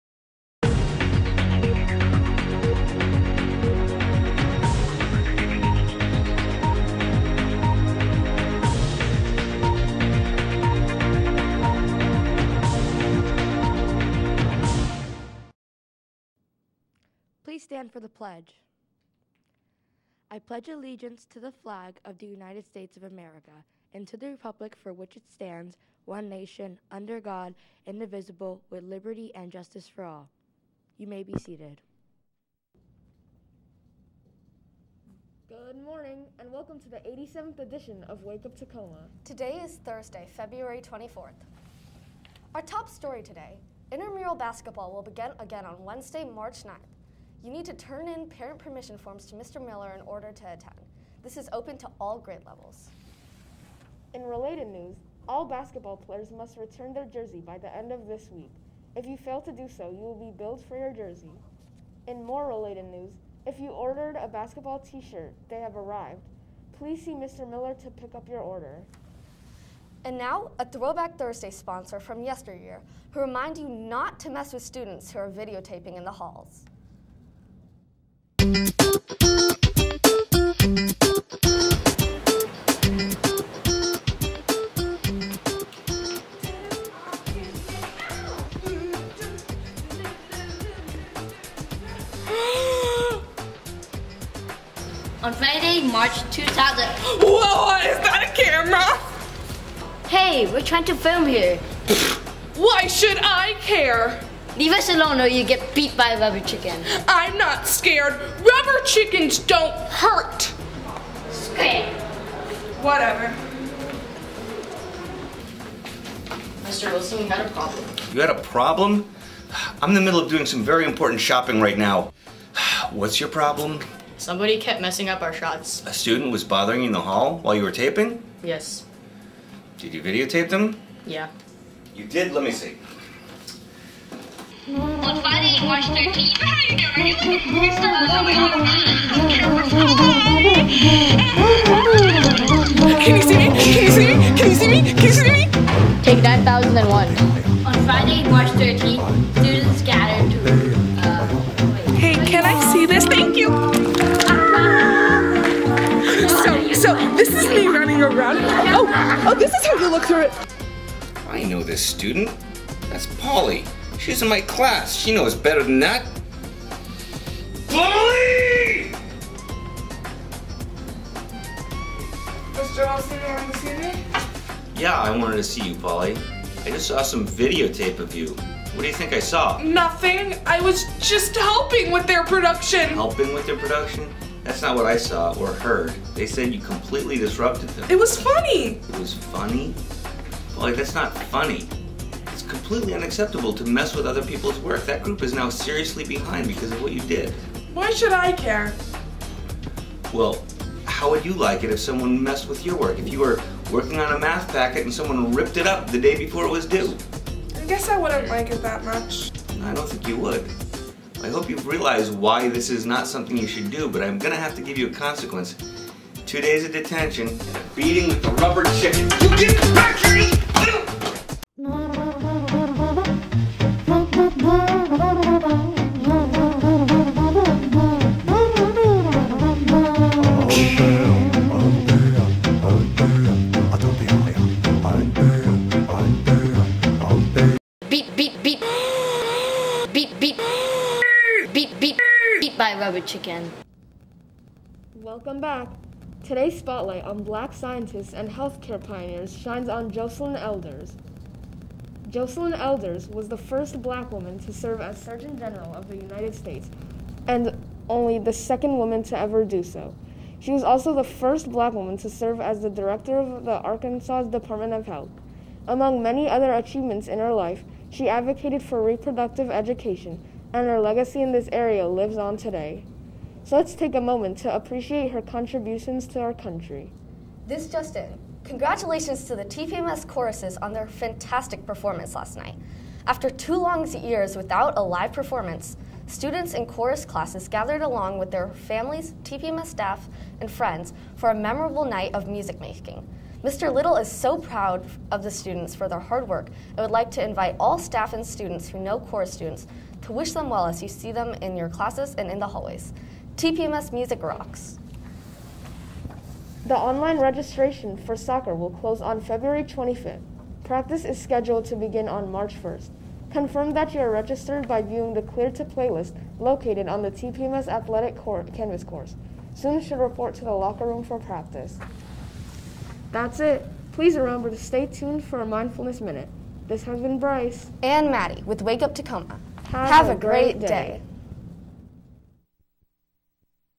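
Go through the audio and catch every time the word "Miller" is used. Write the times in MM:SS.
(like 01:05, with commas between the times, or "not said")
00:49, 01:07.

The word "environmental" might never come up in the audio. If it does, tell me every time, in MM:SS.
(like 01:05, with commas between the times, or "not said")
not said.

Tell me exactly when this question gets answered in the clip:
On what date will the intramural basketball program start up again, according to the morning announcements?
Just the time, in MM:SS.
00:45.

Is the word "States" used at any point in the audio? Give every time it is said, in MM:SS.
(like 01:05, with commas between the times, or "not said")
00:22, 04:16.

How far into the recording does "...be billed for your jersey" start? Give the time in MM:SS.
01:00.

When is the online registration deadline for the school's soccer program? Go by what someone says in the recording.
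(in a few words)
February 25th.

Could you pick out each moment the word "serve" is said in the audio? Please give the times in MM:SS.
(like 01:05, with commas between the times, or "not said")
04:14, 04:22.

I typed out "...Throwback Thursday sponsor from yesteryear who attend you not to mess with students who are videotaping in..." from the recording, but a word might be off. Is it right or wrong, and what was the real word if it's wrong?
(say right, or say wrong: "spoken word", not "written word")
wrong: "remind", not "attend".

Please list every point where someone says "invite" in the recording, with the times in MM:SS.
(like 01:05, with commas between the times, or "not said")
04:57.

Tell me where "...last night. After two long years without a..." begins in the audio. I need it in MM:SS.
04:42.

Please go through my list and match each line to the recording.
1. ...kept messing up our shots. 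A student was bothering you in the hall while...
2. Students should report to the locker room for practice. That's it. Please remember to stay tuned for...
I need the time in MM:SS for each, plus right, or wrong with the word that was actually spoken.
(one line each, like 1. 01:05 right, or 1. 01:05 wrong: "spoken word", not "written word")
1. 02:04 right
2. 05:19 right.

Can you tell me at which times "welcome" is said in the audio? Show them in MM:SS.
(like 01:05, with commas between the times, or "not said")
00:36, 04:04.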